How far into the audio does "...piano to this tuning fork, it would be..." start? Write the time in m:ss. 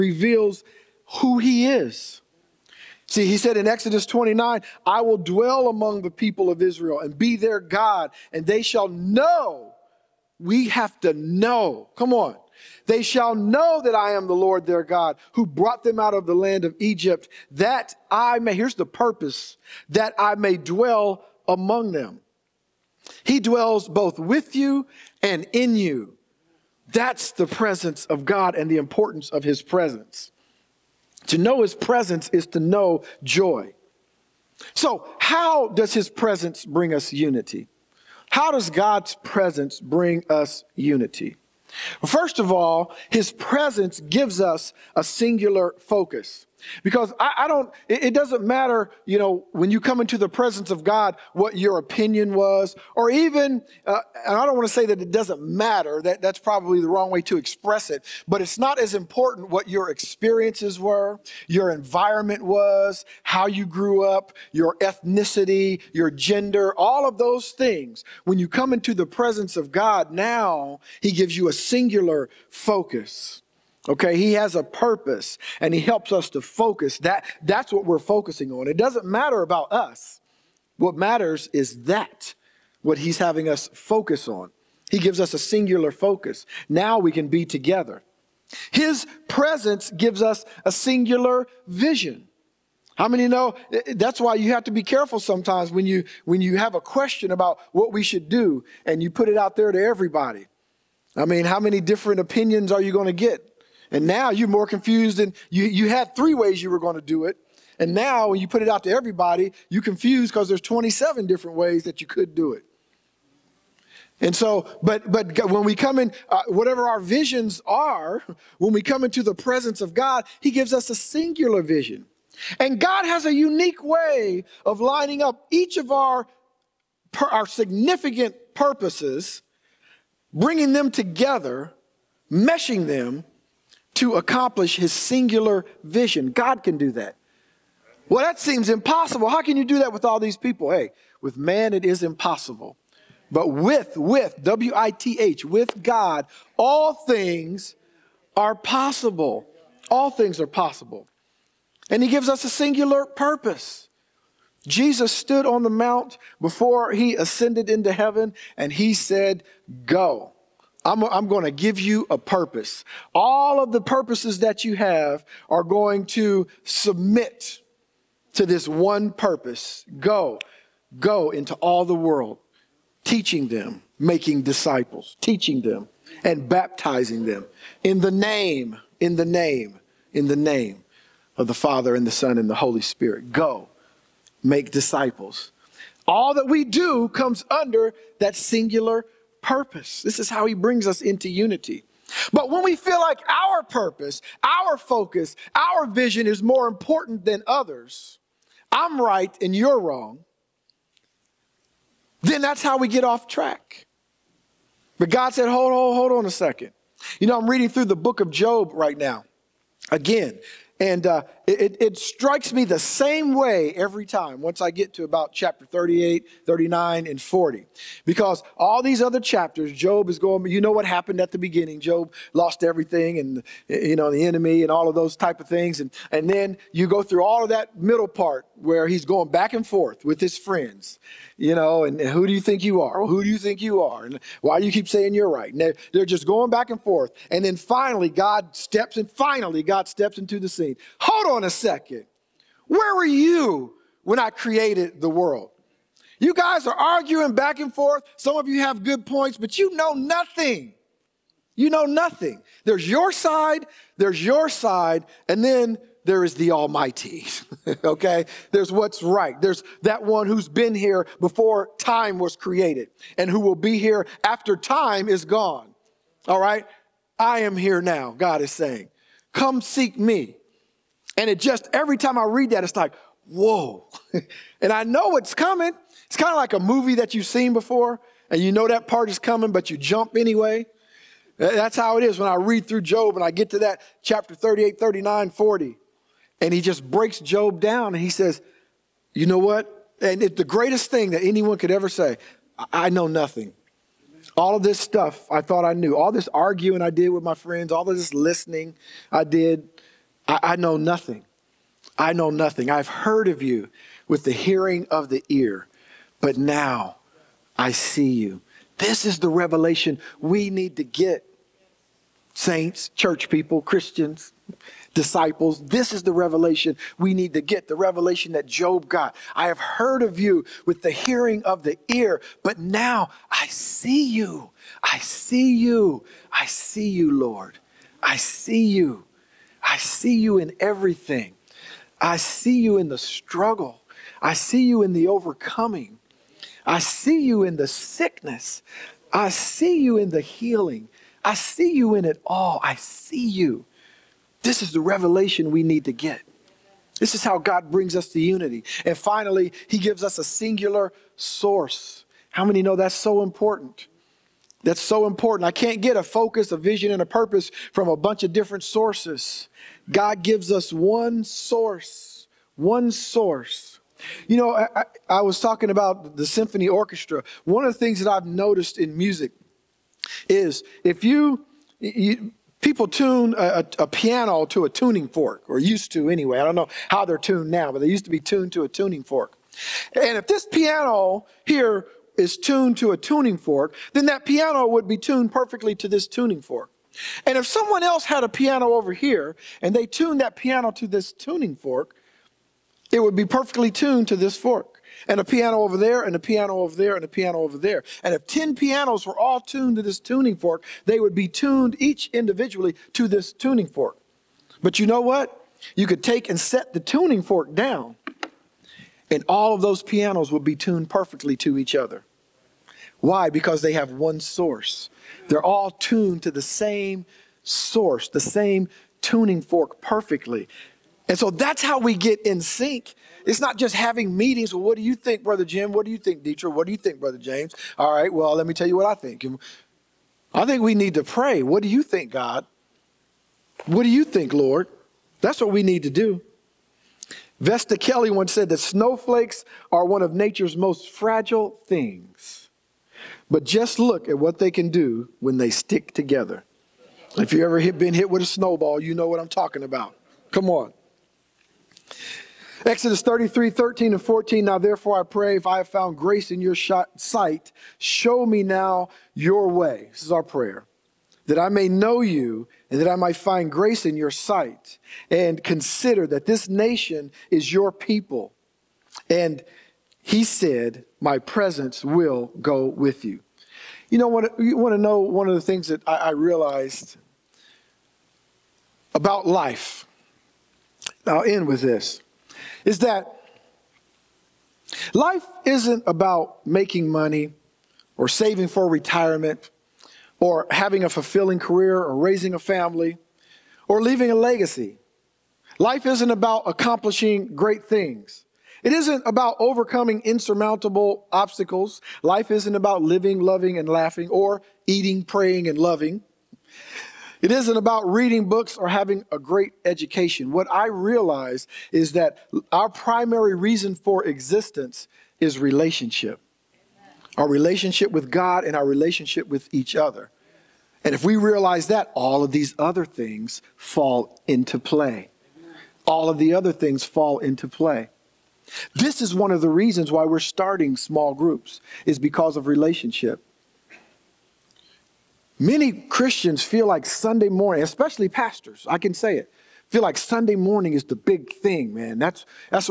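6:30.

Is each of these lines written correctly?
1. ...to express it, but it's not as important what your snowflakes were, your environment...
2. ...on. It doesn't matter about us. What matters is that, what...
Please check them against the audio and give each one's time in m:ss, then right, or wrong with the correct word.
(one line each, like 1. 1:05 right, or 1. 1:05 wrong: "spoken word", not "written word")
1. 0:57 wrong: "experiences", not "snowflakes"
2. 1:18 right.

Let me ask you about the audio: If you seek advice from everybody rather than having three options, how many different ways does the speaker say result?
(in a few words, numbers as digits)
27.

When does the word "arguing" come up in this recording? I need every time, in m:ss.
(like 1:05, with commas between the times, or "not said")
4:06, 4:56.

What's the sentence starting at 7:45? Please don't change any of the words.
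And consider that this nation is your people.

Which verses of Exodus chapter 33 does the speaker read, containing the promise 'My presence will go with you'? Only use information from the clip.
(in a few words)
13 and 14.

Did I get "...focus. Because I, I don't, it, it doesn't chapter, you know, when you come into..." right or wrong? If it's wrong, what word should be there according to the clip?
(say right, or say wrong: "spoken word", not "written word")
wrong: "matter", not "chapter".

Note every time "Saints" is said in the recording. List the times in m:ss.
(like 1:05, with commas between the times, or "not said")
5:12.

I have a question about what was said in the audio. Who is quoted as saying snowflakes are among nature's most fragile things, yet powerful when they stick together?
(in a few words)
Vesta Kelly.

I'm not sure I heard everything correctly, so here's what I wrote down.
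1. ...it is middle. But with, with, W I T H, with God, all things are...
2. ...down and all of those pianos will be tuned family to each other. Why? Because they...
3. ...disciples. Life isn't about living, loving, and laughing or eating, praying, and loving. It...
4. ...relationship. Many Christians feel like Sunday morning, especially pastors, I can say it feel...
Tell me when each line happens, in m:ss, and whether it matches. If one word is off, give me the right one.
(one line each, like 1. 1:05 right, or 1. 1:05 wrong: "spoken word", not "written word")
1. 2:21 wrong: "impossible", not "middle"
2. 6:47 wrong: "perfectly", not "family"
3. 8:21 wrong: "obstacles", not "disciples"
4. 8:52 right.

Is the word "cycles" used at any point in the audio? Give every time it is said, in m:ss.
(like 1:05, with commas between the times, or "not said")
not said.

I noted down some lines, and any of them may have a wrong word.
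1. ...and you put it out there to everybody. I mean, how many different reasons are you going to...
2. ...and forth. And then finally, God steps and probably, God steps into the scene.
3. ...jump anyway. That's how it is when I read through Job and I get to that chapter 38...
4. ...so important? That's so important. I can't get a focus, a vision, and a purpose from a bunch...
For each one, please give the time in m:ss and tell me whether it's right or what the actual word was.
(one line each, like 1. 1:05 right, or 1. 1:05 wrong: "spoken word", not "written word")
1. 1:38 wrong: "opinions", not "reasons"
2. 3:56 wrong: "finally", not "probably"
3. 4:39 right
4. 5:52 right.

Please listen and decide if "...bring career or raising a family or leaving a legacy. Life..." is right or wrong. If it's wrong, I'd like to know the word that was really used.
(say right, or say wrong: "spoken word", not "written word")
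wrong: "fulfilling", not "bring".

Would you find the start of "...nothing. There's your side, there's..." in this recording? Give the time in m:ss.
4:11.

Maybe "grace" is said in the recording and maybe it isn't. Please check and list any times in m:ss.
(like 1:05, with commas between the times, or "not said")
7:35, 7:43.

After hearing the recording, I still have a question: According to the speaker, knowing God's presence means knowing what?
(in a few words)
Joy.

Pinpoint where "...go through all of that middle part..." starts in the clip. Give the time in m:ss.
3:46.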